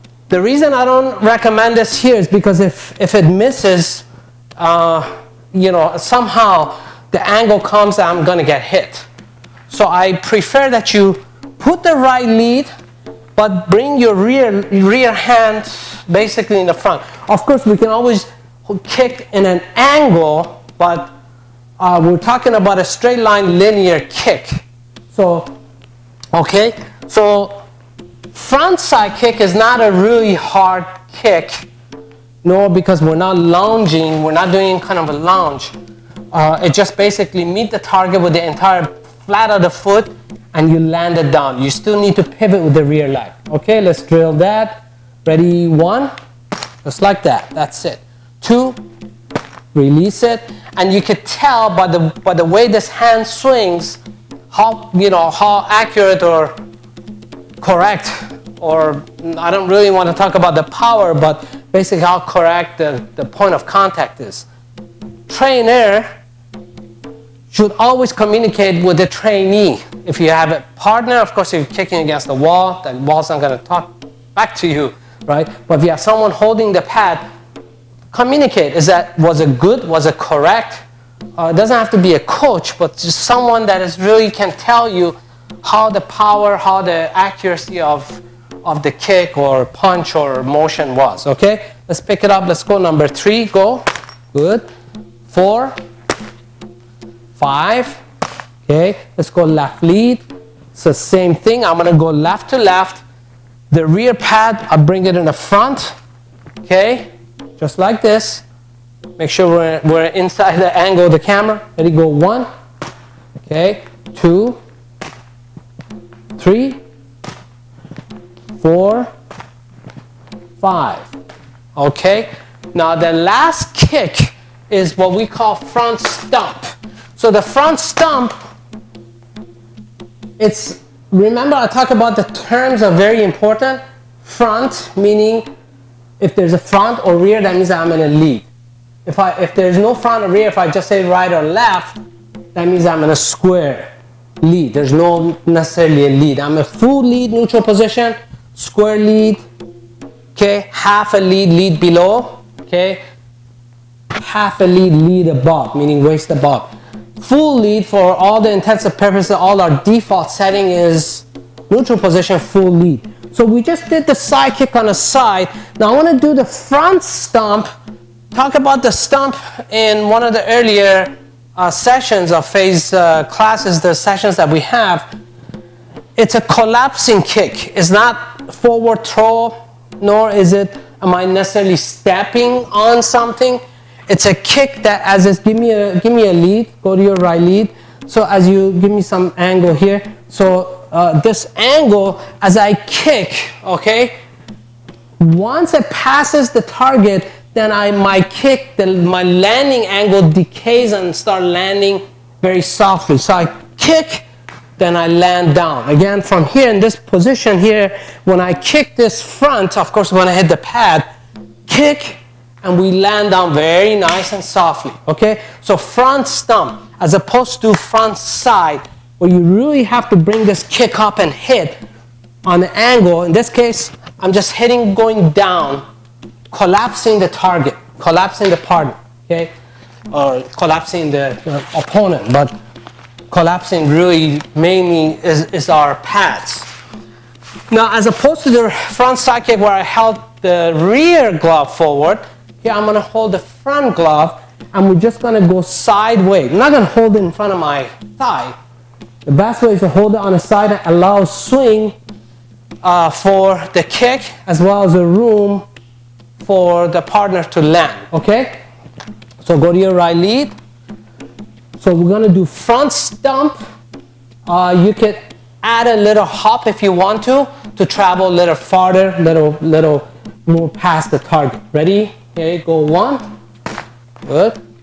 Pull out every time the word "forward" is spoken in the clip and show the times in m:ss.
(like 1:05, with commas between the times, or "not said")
2:58, 4:01.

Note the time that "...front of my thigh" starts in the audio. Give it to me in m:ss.
4:07.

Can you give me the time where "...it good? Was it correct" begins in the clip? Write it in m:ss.
1:19.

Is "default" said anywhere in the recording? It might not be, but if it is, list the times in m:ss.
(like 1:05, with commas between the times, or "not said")
2:39.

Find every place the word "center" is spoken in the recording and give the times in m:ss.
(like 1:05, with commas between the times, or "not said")
not said.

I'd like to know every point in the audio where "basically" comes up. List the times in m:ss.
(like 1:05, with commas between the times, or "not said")
0:16, 0:36, 1:01.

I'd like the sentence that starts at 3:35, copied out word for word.
So front stomp as opposed to front side where you really have to bring this kick up and hit on the angle.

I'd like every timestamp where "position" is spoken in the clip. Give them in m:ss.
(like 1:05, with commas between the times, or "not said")
2:27, 2:41, 3:26.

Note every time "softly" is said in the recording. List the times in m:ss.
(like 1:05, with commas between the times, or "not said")
3:22, 3:34.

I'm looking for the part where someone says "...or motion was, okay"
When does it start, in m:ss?
1:30.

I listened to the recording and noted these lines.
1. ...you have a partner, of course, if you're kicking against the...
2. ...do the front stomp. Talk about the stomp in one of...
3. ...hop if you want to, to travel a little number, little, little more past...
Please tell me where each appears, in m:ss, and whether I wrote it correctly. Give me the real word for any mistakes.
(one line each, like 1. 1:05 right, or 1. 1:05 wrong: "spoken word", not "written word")
1. 1:10 right
2. 2:46 right
3. 4:26 wrong: "farther", not "number".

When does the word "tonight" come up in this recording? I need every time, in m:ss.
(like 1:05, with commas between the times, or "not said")
not said.